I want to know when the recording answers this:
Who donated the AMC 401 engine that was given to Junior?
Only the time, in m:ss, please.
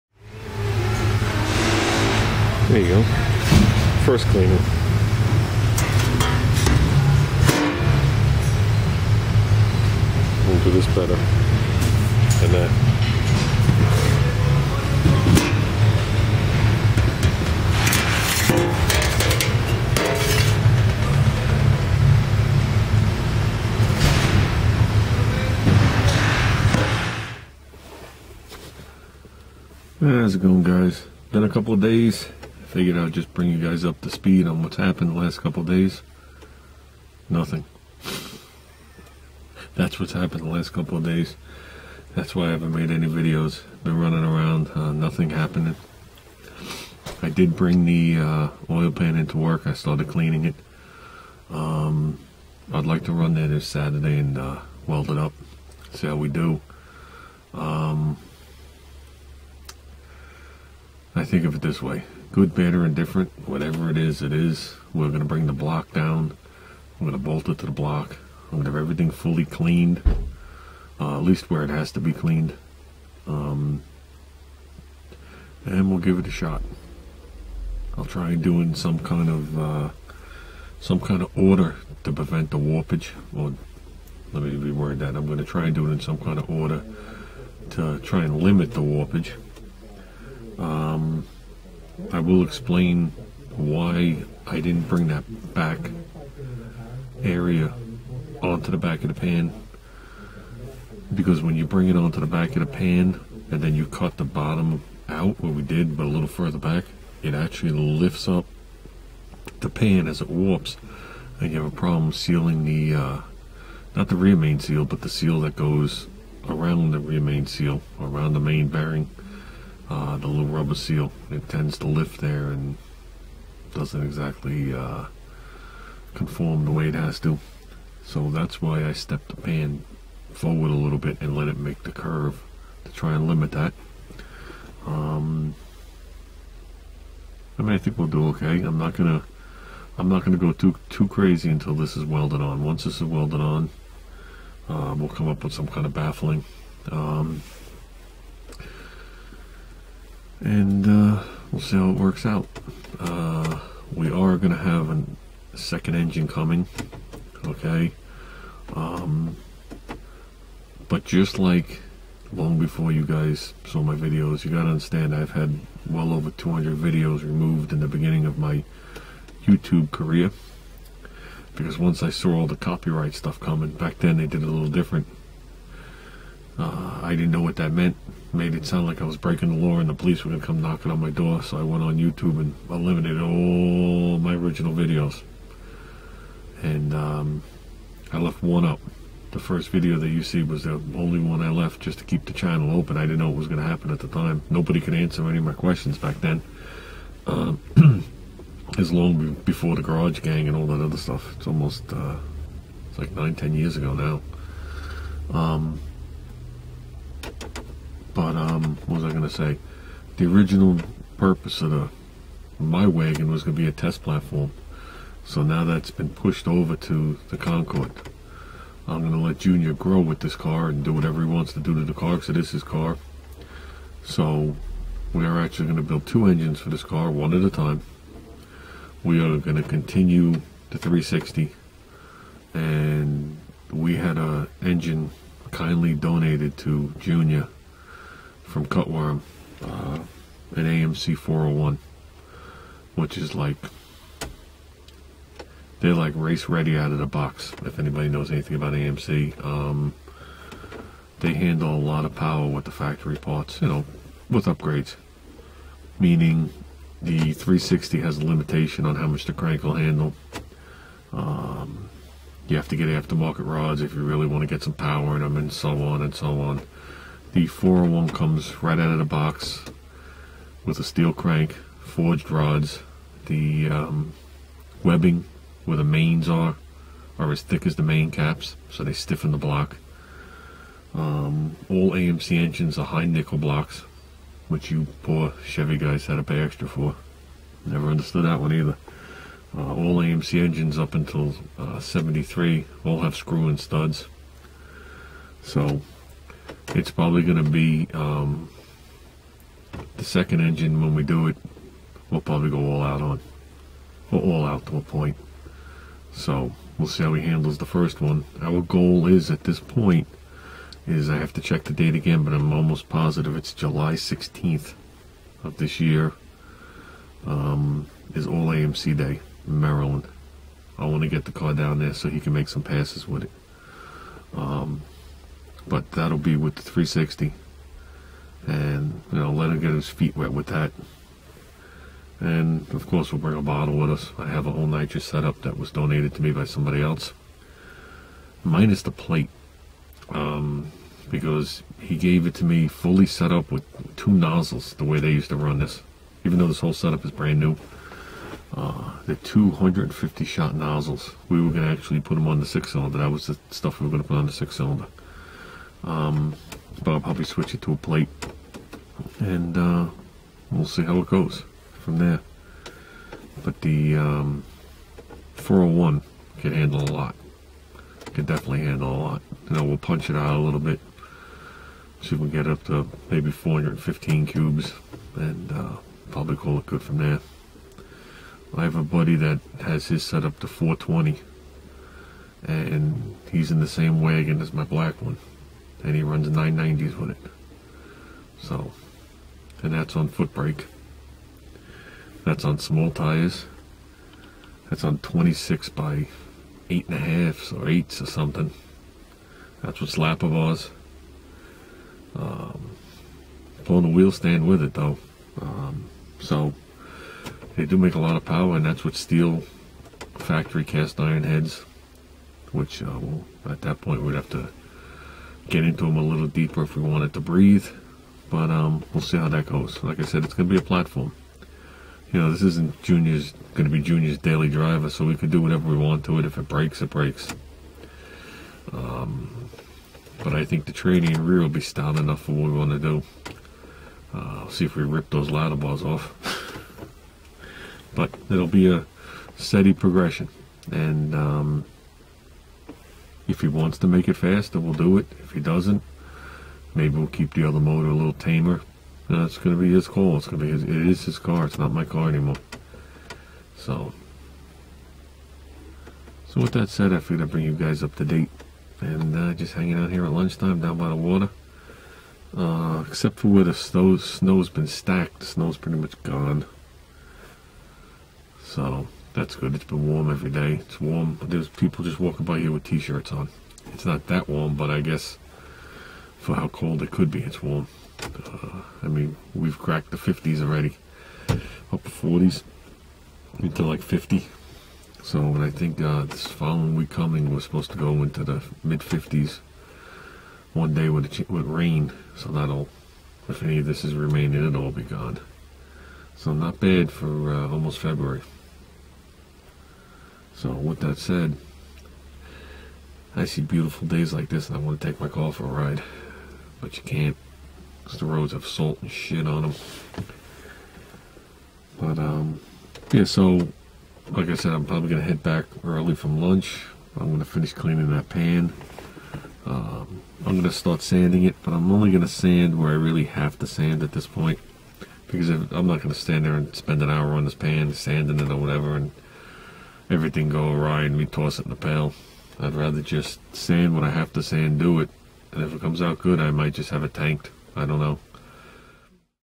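3:58.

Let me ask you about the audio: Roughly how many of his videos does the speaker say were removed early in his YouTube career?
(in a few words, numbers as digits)
over 200.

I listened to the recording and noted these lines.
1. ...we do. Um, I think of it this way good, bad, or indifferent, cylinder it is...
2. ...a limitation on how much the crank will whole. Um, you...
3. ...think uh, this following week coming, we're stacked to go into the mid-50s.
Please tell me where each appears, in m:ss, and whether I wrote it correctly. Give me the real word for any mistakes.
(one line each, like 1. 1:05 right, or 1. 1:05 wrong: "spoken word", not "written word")
1. 0:56 wrong: "whatever", not "cylinder"
2. 4:18 wrong: "handle", not "whole"
3. 8:05 wrong: "supposed", not "stacked".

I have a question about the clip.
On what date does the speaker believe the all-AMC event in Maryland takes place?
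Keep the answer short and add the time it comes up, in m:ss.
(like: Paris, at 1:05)
July 16th, at 5:13.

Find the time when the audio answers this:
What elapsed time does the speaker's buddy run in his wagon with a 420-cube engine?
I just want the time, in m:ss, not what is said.
6:26.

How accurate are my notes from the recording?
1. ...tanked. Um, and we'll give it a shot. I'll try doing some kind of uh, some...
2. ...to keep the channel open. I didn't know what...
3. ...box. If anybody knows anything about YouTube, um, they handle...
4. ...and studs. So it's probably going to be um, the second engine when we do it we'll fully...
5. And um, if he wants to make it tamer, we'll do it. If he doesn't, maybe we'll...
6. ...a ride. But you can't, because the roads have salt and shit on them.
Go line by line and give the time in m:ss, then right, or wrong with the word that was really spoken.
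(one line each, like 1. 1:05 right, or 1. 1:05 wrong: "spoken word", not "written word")
1. 1:12 wrong: "cleaned", not "tanked"
2. 3:11 right
3. 4:07 wrong: "AMC", not "YouTube"
4. 4:53 wrong: "probably", not "fully"
5. 7:20 wrong: "faster", not "tamer"
6. 8:25 right.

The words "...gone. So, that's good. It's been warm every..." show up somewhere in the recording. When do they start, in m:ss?
7:46.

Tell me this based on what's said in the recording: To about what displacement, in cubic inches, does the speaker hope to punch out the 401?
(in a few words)
415.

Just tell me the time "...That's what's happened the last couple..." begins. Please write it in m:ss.
0:39.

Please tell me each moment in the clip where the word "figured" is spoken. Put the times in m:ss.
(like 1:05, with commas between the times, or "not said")
0:32, 7:36.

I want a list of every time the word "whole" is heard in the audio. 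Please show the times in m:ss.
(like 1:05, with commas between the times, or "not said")
5:34, 5:46.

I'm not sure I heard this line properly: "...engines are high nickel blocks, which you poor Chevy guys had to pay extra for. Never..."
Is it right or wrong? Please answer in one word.
right.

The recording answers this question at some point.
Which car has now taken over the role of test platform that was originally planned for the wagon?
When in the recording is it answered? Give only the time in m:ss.
3:37.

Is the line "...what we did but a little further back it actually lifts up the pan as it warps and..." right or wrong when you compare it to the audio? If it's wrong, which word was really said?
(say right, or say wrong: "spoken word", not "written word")
right.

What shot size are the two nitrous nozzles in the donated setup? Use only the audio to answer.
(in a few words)
250.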